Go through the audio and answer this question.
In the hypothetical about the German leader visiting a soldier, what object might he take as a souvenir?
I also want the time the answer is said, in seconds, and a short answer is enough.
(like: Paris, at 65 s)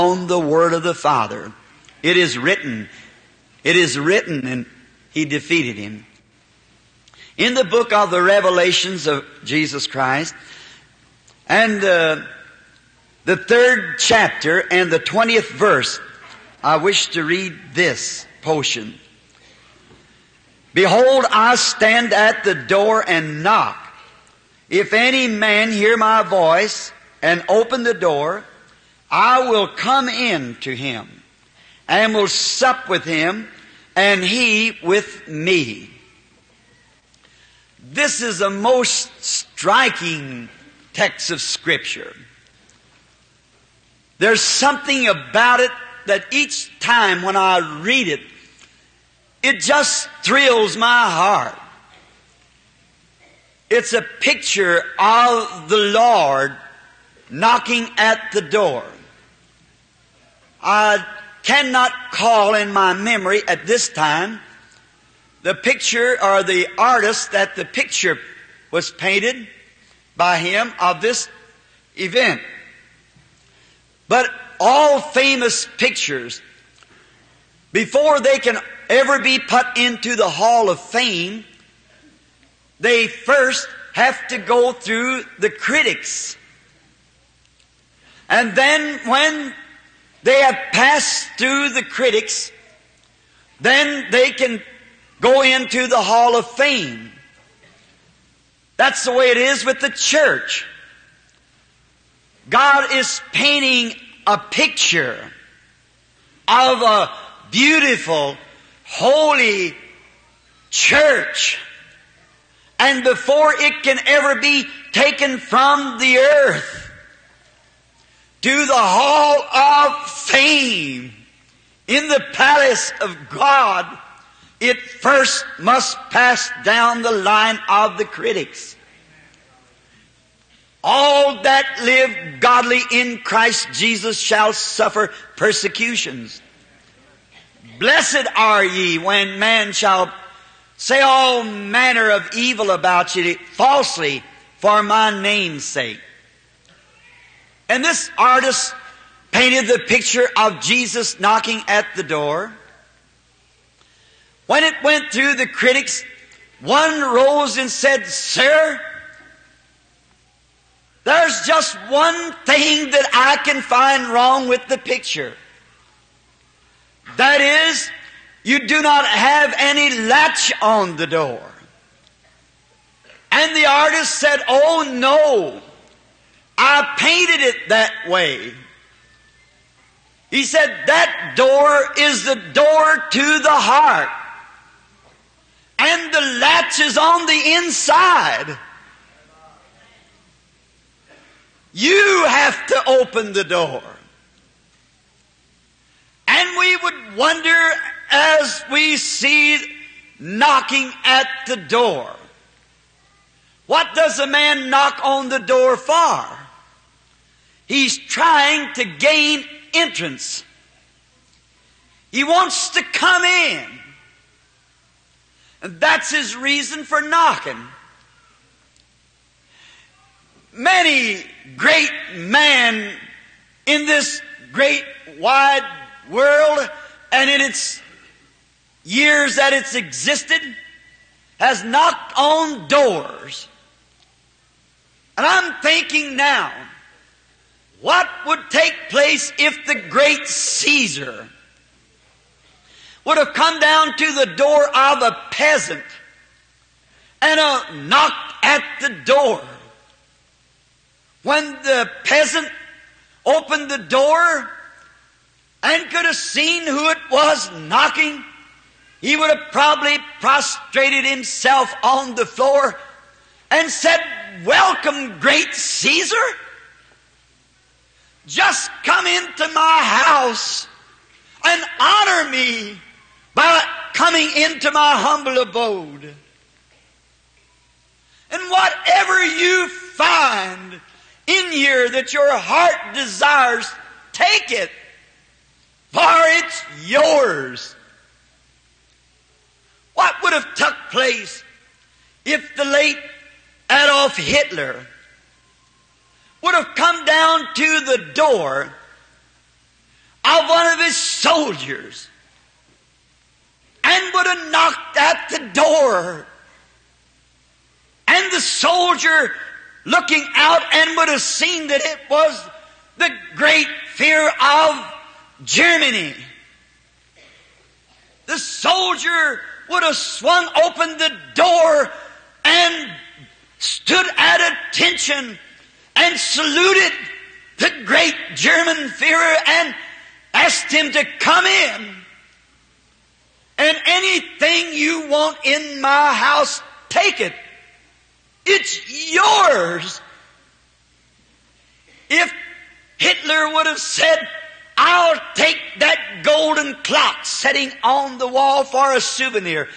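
golden clock, at 346 s.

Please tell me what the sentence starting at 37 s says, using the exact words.
This is the most striking text of Scripture.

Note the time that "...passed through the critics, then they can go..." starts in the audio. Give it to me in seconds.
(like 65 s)
90 s.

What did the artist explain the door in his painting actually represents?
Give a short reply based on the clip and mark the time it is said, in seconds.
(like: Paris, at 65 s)
the heart, at 182 s.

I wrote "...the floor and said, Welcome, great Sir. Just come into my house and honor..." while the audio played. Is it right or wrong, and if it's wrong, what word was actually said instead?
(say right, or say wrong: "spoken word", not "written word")
wrong: "Caesar", not "Sir".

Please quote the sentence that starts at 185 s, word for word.
And the latch is on the inside.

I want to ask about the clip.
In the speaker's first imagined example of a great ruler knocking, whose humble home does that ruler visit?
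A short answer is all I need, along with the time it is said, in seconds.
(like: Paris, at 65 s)
a peasant, at 245 s.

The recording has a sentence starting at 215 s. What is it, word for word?
And that's his reason for knocking.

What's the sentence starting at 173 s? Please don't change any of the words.
And the artist said, Oh no, I painted it that way.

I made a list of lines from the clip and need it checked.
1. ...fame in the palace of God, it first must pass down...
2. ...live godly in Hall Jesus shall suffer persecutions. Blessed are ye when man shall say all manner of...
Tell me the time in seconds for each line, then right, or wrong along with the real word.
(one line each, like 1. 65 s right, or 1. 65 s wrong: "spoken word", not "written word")
1. 120 s right
2. 131 s wrong: "Christ", not "Hall".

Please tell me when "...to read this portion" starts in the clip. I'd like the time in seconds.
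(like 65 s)
17 s.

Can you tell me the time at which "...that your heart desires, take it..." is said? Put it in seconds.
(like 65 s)
281 s.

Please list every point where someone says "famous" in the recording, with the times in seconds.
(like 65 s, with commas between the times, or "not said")
74 s.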